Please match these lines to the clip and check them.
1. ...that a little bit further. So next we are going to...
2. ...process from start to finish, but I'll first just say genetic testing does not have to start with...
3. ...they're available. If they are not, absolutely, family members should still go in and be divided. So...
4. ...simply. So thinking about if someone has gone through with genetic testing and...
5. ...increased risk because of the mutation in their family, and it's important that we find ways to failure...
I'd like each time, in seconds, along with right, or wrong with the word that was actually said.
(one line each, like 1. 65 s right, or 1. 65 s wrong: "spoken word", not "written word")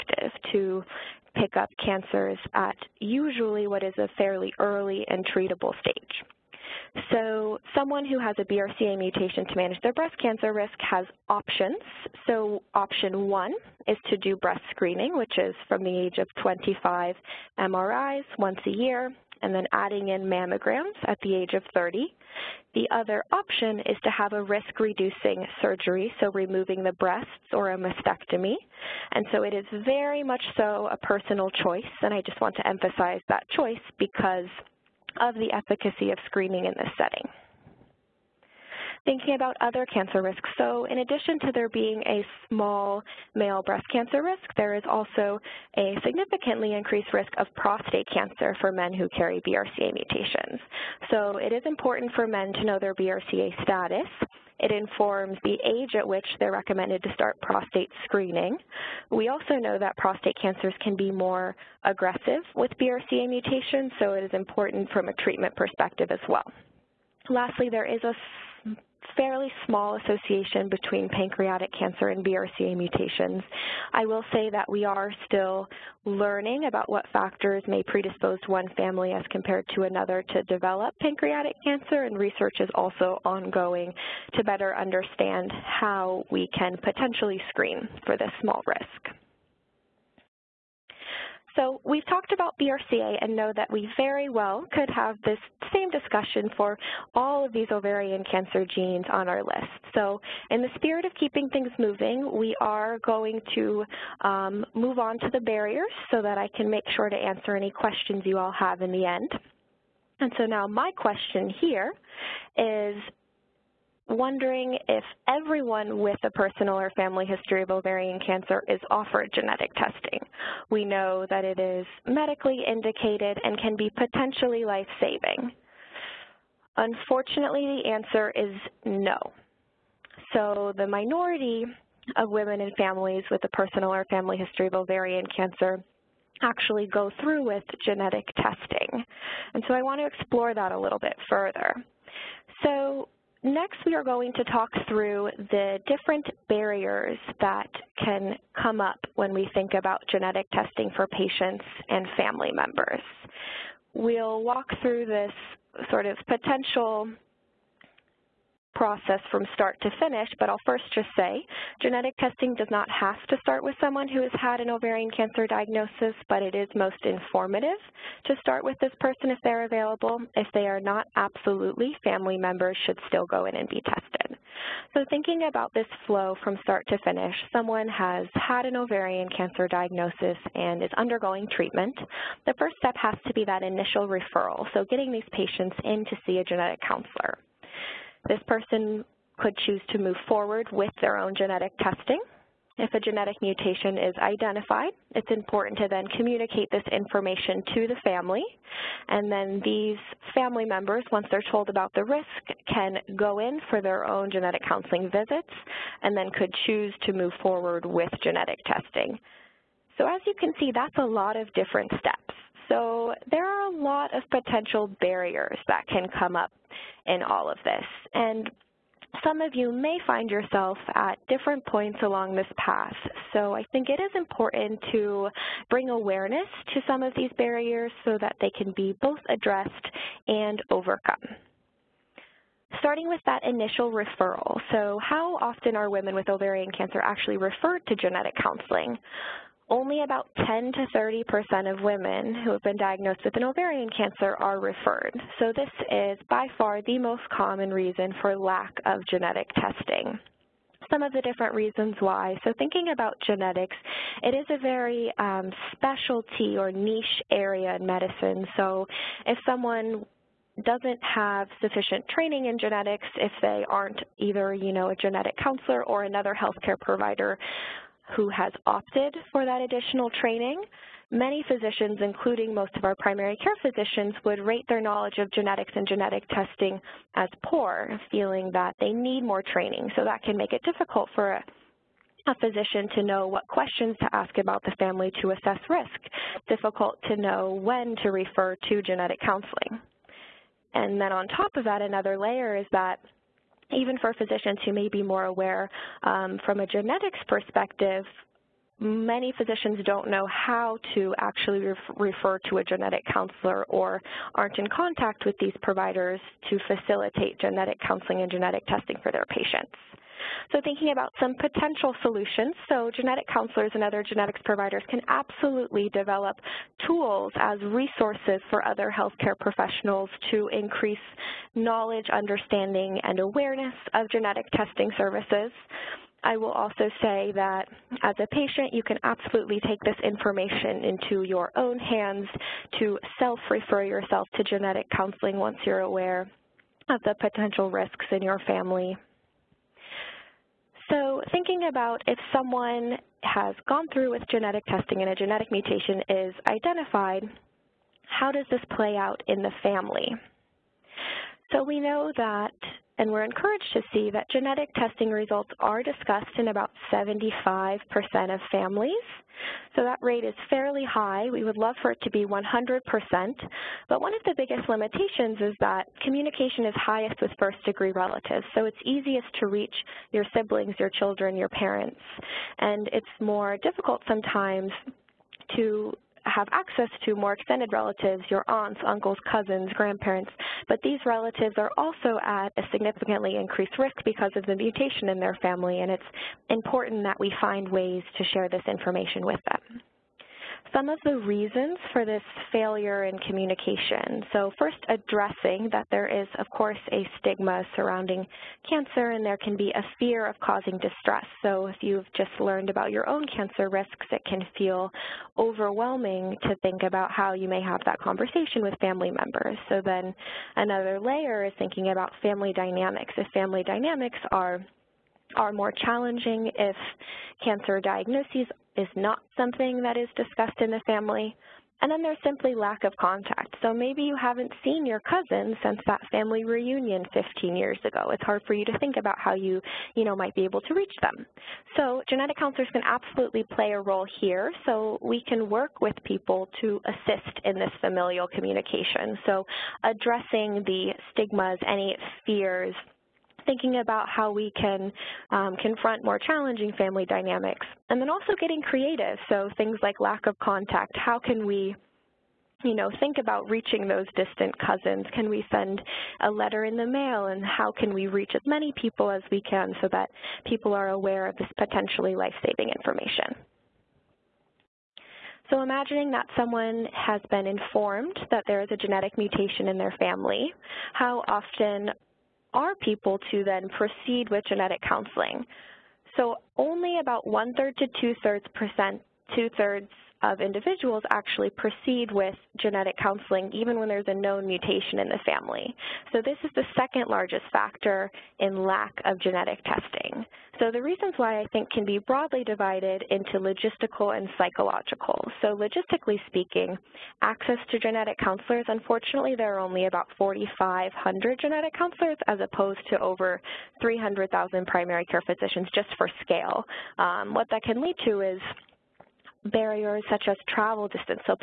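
1. 140 s right
2. 158 s right
3. 169 s wrong: "tested", not "divided"
4. 338 s wrong: "family", not "simply"
5. 383 s wrong: "share", not "failure".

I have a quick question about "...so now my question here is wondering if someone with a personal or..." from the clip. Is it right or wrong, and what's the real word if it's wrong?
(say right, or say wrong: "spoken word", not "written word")
wrong: "everyone", not "someone".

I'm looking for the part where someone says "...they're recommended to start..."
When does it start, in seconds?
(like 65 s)
56 s.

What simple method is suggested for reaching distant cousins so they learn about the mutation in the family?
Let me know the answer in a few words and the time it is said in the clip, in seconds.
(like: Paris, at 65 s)
a letter in the mail, at 456 s.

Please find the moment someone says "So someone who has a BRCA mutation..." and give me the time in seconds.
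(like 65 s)
7 s.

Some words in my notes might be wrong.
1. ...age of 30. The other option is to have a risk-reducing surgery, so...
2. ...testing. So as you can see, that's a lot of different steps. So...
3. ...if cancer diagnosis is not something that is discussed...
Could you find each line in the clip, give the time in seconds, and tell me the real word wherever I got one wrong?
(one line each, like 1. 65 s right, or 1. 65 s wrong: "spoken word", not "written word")
1. 21 s right
2. 208 s right
3. 416 s right.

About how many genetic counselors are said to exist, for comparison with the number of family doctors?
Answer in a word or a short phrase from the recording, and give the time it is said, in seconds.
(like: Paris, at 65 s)
4,500, at 500 s.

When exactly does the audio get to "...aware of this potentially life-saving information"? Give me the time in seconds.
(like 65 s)
460 s.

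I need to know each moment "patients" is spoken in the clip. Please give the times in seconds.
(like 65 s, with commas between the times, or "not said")
151 s, 185 s, 309 s, 328 s.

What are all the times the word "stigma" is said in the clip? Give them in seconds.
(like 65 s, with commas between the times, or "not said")
397 s, 441 s.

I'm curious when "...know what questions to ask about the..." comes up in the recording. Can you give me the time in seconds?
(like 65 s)
283 s.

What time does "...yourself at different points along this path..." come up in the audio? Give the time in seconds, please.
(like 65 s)
220 s.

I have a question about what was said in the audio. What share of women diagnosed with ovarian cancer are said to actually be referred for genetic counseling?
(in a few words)
10 to 30 percent.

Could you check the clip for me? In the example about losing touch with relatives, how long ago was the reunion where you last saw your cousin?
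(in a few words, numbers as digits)
15 years.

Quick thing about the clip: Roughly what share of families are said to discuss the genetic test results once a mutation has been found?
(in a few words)
75%.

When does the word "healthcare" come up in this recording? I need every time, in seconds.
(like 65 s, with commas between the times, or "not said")
266 s, 318 s.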